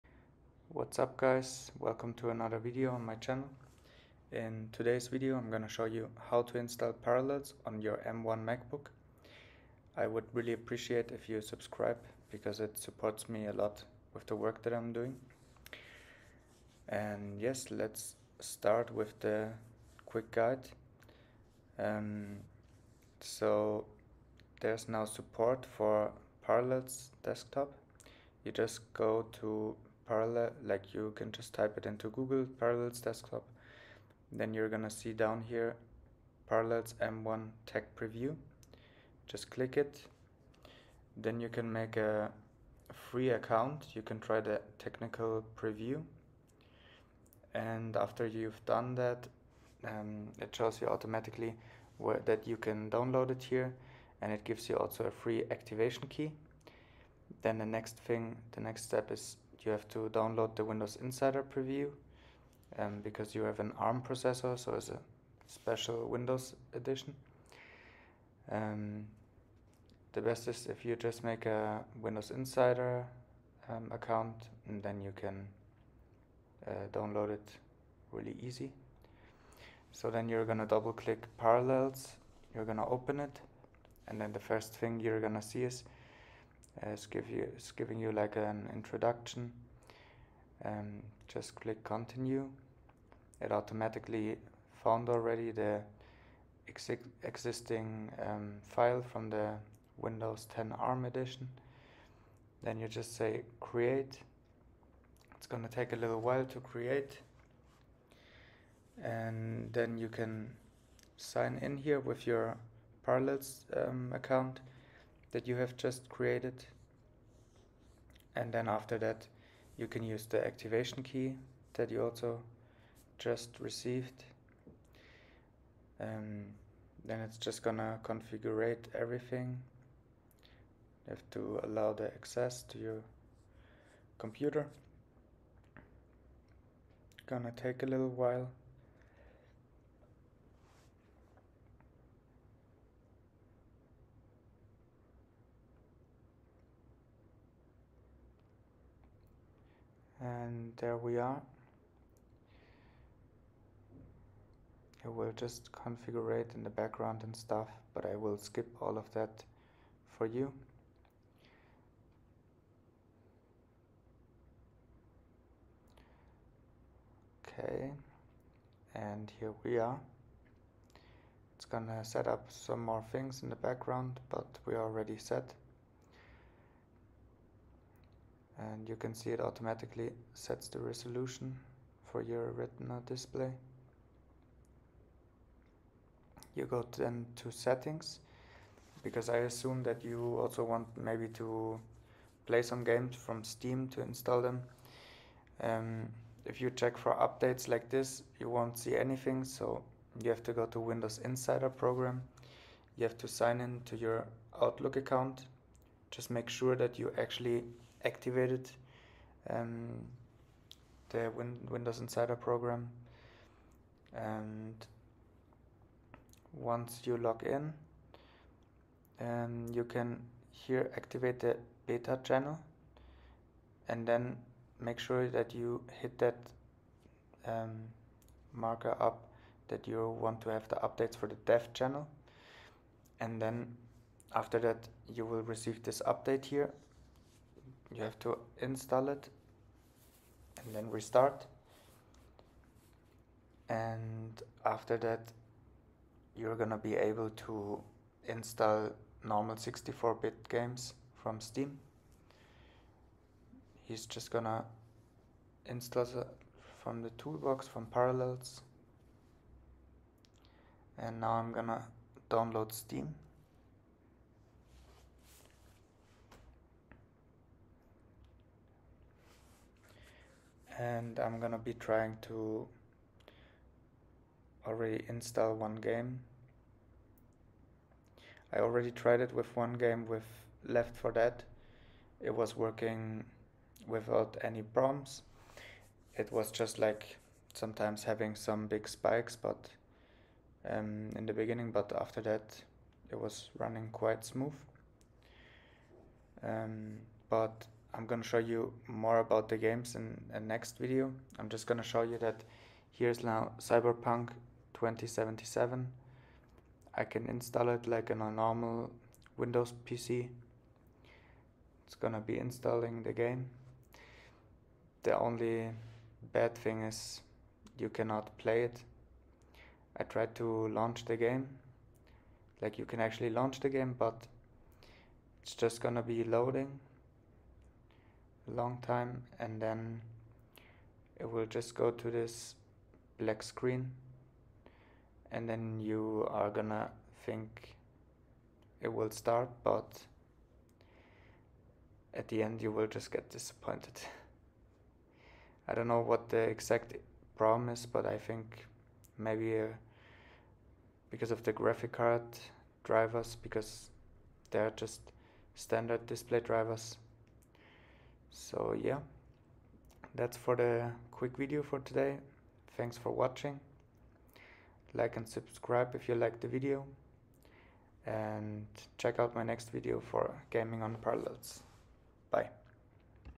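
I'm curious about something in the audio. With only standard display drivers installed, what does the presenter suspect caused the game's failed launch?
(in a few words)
graphic card drivers.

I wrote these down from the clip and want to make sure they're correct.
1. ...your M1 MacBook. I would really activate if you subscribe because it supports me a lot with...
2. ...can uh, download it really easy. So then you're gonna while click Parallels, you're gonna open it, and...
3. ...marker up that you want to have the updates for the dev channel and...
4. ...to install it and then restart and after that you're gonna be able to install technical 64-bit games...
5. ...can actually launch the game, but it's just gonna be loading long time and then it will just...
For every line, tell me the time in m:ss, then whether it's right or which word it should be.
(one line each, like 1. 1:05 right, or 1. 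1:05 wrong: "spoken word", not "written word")
1. 0:07 wrong: "appreciate", not "activate"
2. 1:15 wrong: "double", not "while"
3. 3:48 right
4. 3:58 wrong: "normal", not "technical"
5. 5:22 right.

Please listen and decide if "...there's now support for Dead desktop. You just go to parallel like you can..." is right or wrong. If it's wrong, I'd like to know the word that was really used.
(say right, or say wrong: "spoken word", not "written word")
wrong: "Parallels", not "Dead".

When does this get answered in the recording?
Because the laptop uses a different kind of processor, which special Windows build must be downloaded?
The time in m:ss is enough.
1:00.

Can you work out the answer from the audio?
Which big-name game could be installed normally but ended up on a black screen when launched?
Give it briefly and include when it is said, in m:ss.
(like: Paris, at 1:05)
Cyberpunk 2077, at 5:03.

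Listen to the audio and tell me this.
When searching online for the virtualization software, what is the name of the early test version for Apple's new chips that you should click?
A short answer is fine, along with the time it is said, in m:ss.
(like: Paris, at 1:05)
Parallels M1 Tech Preview, at 0:36.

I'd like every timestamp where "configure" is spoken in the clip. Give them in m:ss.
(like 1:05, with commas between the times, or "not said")
2:08, 2:35.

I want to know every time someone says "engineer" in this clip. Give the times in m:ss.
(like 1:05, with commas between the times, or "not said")
not said.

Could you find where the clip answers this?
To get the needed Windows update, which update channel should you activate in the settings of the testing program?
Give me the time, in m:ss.
3:41.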